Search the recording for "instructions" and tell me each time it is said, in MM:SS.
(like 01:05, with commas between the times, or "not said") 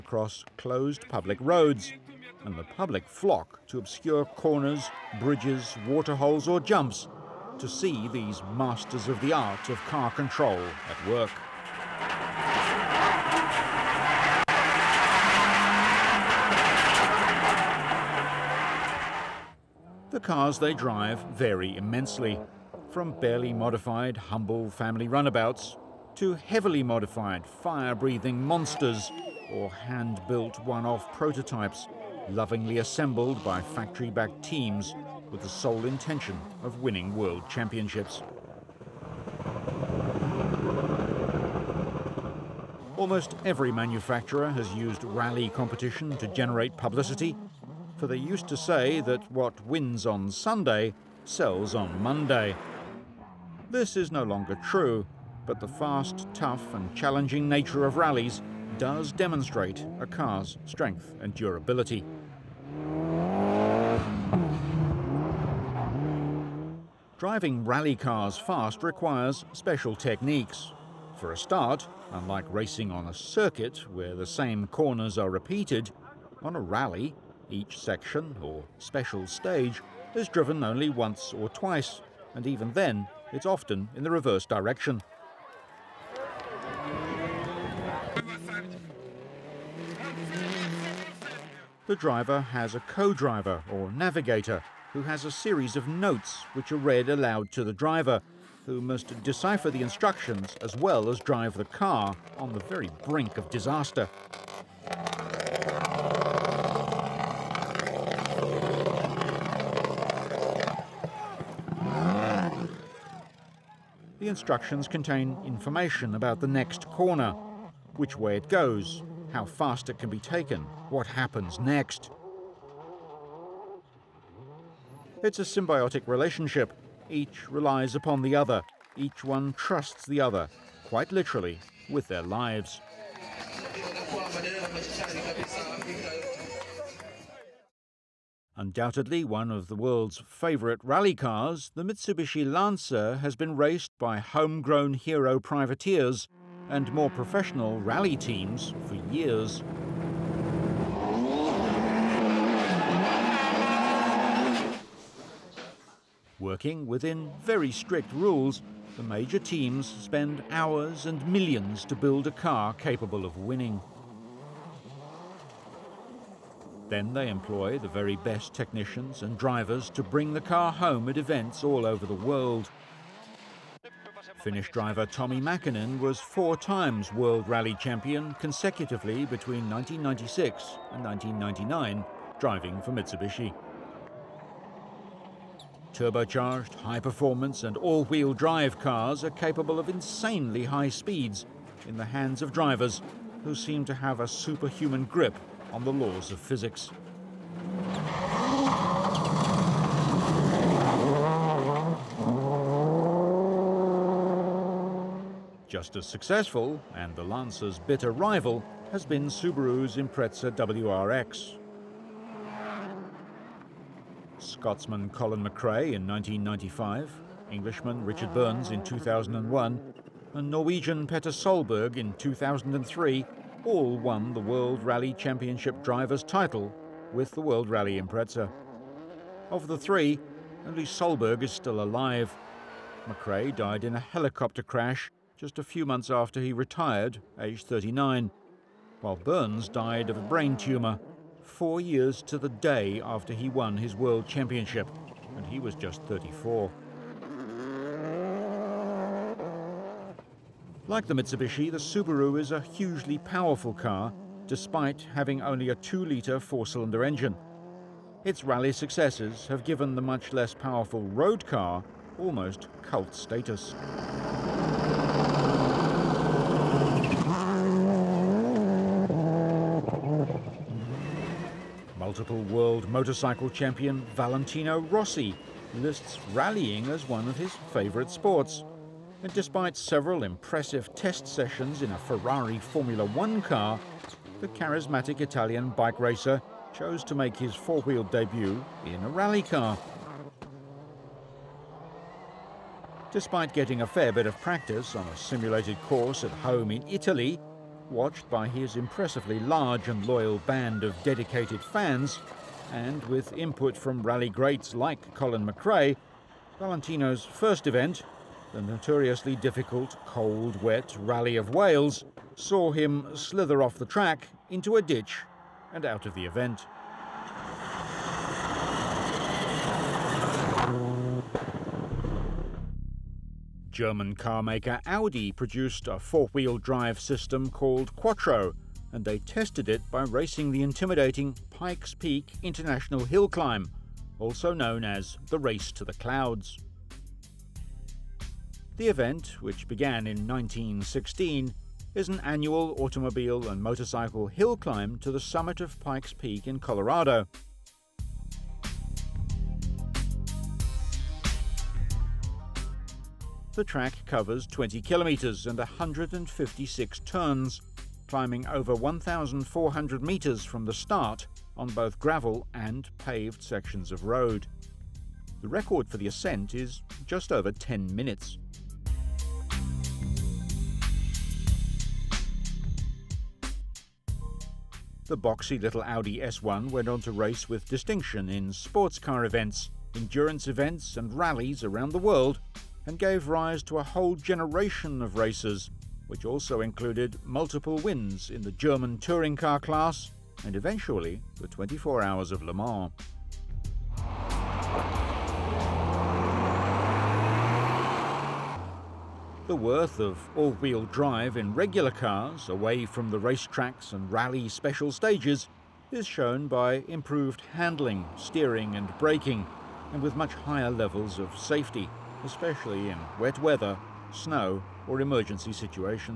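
01:39, 01:54.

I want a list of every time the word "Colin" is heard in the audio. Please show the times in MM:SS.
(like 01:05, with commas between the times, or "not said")
03:35, 05:05.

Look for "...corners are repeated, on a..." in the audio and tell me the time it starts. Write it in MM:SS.
01:14.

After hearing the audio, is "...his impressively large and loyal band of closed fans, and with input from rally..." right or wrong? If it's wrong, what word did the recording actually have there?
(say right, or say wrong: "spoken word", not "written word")
wrong: "dedicated", not "closed".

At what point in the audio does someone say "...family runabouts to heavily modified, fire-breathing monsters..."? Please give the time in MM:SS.
00:24.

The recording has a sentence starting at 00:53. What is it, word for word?
This is no longer true, but the fast, tough and challenging nature of rallies does demonstrate a car's strength and durability.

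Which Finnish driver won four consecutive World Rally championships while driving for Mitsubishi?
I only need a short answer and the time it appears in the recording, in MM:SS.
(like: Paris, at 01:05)
Tommy Mäkinen, at 02:55.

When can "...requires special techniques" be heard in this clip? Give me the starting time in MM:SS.
01:08.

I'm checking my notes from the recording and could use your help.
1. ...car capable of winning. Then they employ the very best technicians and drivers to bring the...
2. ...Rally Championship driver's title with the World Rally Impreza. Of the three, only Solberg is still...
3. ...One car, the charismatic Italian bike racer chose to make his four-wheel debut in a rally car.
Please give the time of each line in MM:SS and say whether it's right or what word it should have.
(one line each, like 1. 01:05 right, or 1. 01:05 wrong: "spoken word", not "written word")
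1. 02:42 right
2. 03:44 right
3. 04:43 right.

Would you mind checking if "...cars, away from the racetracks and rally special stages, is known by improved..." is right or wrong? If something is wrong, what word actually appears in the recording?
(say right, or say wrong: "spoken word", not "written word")
wrong: "shown", not "known".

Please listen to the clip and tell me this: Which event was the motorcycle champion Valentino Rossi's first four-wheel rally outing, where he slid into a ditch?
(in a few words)
Rally of Wales.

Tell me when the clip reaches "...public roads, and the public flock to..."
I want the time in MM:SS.
00:01.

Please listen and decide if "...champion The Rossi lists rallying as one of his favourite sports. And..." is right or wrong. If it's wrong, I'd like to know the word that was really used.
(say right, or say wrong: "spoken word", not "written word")
wrong: "Valentino", not "The".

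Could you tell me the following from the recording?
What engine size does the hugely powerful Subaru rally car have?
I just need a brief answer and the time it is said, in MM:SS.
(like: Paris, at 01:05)
2-litre, at 04:15.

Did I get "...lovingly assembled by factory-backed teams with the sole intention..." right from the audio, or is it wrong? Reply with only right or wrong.
right.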